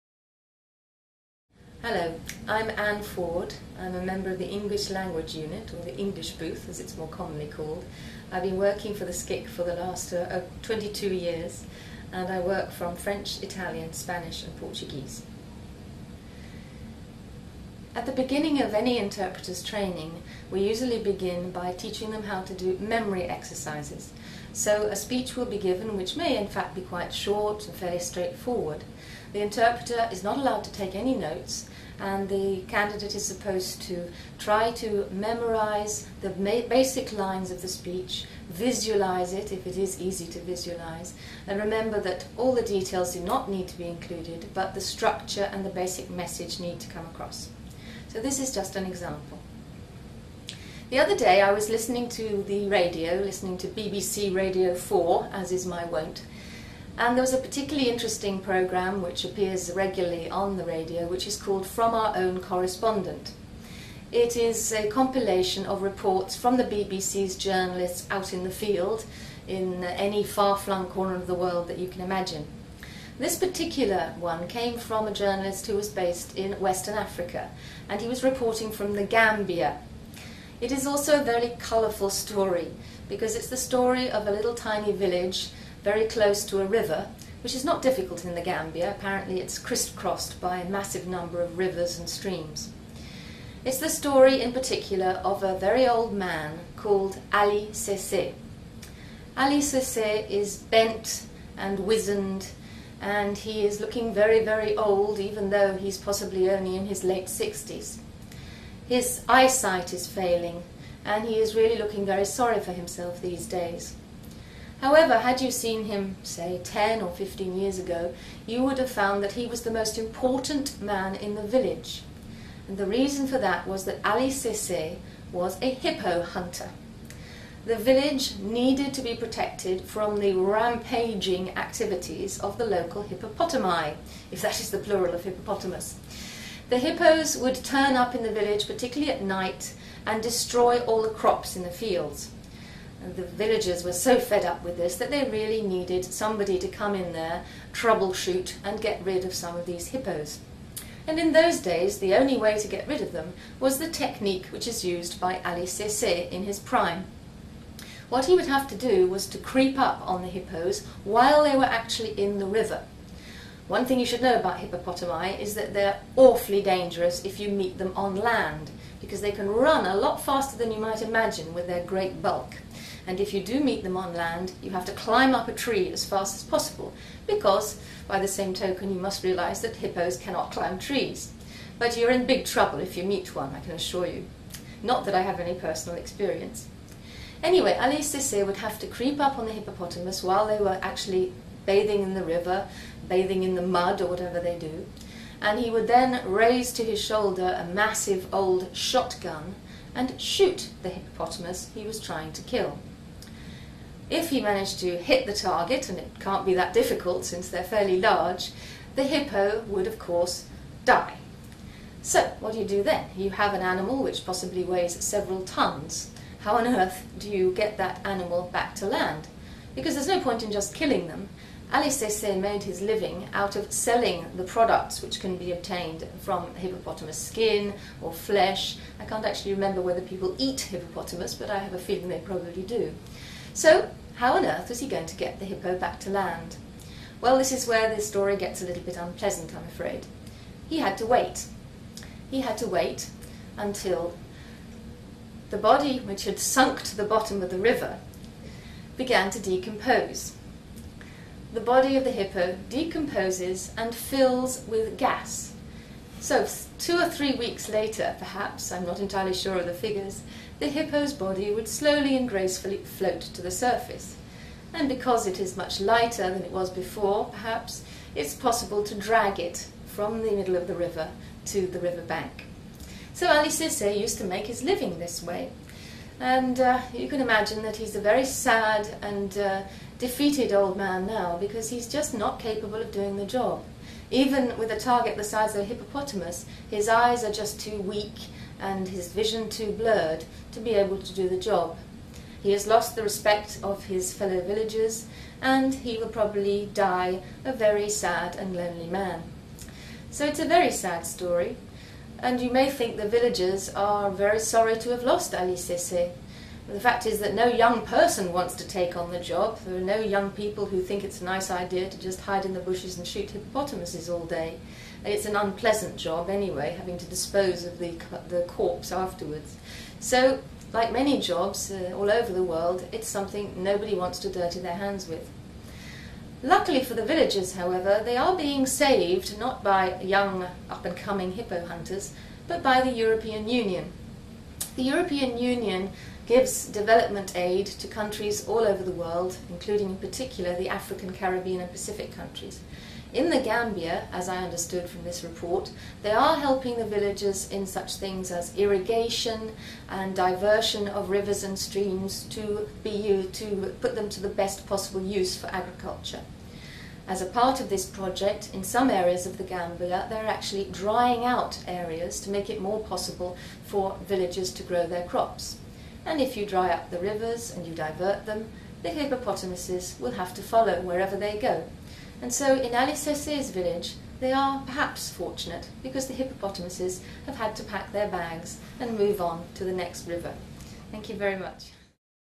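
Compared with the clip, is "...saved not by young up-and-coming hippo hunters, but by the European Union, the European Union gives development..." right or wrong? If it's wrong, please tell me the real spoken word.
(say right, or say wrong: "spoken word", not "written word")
right.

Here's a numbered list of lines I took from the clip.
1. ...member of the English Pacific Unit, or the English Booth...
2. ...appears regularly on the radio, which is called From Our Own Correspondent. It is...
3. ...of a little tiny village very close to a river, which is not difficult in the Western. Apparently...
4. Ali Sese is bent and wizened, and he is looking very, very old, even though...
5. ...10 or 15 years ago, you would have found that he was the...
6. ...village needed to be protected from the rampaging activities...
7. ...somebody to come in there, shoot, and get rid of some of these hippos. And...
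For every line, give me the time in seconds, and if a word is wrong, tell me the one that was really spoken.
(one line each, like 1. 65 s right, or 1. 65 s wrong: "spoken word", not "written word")
1. 4 s wrong: "Language", not "Pacific"
2. 59 s right
3. 84 s wrong: "Gambia", not "Western"
4. 99 s right
5. 116 s right
6. 127 s right
7. 146 s wrong: "troubleshoot", not "shoot".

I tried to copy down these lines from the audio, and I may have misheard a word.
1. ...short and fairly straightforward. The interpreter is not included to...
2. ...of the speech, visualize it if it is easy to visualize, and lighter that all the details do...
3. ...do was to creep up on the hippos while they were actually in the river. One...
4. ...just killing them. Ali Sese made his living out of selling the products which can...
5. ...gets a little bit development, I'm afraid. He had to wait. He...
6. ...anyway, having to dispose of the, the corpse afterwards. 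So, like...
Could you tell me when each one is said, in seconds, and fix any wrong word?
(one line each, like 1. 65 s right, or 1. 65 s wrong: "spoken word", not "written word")
1. 27 s wrong: "allowed", not "included"
2. 37 s wrong: "remember", not "lighter"
3. 158 s right
4. 220 s right
5. 238 s wrong: "unpleasant", not "development"
6. 316 s right.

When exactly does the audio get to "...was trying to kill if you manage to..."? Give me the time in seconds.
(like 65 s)
201 s.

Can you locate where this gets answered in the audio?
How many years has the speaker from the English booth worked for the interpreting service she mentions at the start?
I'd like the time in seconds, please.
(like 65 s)
10 s.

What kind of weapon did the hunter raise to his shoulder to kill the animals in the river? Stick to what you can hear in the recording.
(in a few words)
shotgun.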